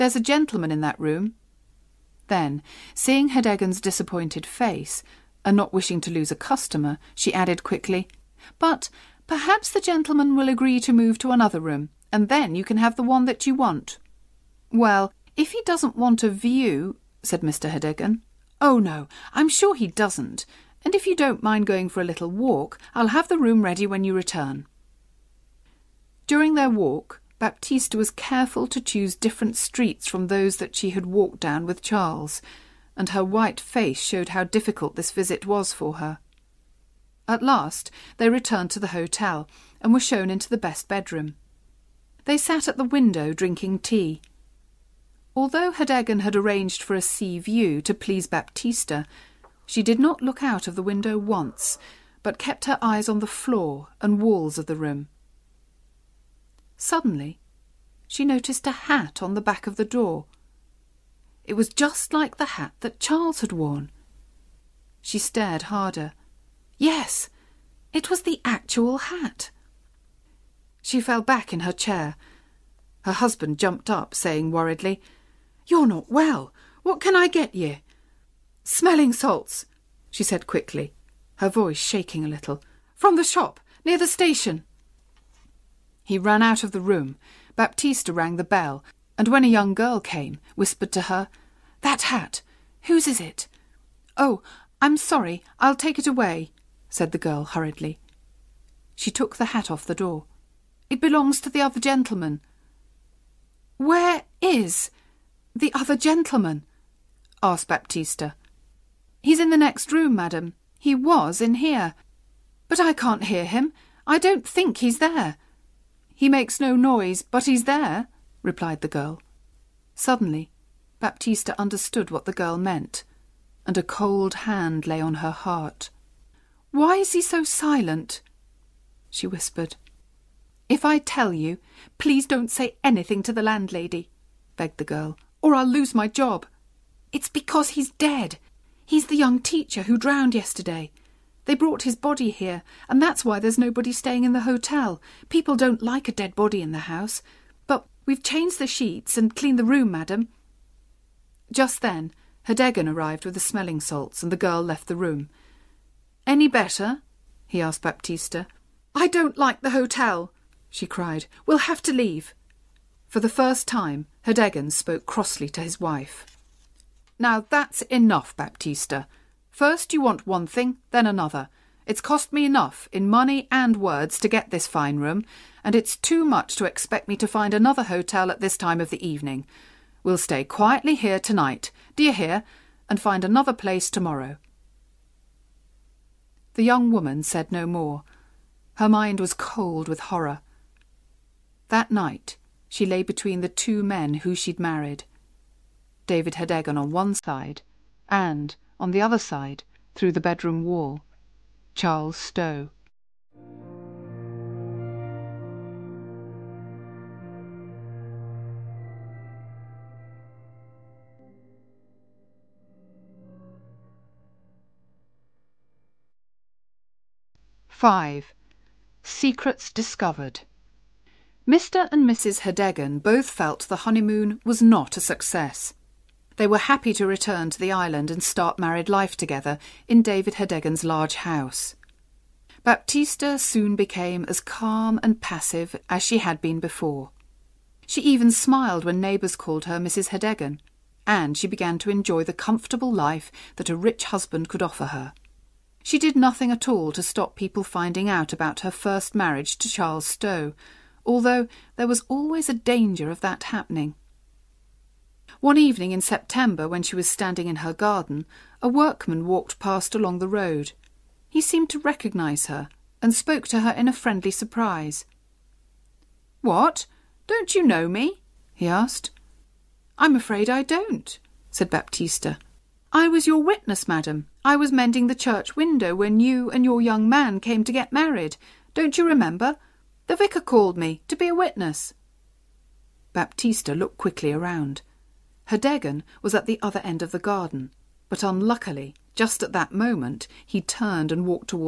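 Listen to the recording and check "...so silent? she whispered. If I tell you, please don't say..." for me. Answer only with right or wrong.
right.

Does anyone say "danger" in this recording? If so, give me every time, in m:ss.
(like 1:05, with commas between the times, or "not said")
4:12.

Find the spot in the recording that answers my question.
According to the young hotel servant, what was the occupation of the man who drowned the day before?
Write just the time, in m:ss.
2:19.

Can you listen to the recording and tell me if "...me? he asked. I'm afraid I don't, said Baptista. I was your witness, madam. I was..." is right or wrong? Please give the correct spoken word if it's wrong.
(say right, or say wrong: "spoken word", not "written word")
right.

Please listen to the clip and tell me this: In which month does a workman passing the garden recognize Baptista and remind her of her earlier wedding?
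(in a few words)
September.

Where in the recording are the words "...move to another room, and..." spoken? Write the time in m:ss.
0:10.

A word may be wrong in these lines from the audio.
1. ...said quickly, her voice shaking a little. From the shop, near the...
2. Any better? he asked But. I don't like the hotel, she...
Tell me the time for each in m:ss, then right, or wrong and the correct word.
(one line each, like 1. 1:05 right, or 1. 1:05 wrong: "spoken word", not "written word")
1. 1:20 right
2. 2:36 wrong: "Baptista", not "But".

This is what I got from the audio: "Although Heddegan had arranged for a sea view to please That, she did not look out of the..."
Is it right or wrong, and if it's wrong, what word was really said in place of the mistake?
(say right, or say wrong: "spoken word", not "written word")
wrong: "Baptista", not "That".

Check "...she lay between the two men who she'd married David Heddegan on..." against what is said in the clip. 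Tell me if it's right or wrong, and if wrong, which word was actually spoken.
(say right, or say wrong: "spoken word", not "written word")
right.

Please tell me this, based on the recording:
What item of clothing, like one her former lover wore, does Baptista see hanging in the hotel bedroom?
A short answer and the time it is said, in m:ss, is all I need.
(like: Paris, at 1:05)
a hat, at 0:58.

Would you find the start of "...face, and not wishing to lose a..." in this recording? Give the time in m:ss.
0:04.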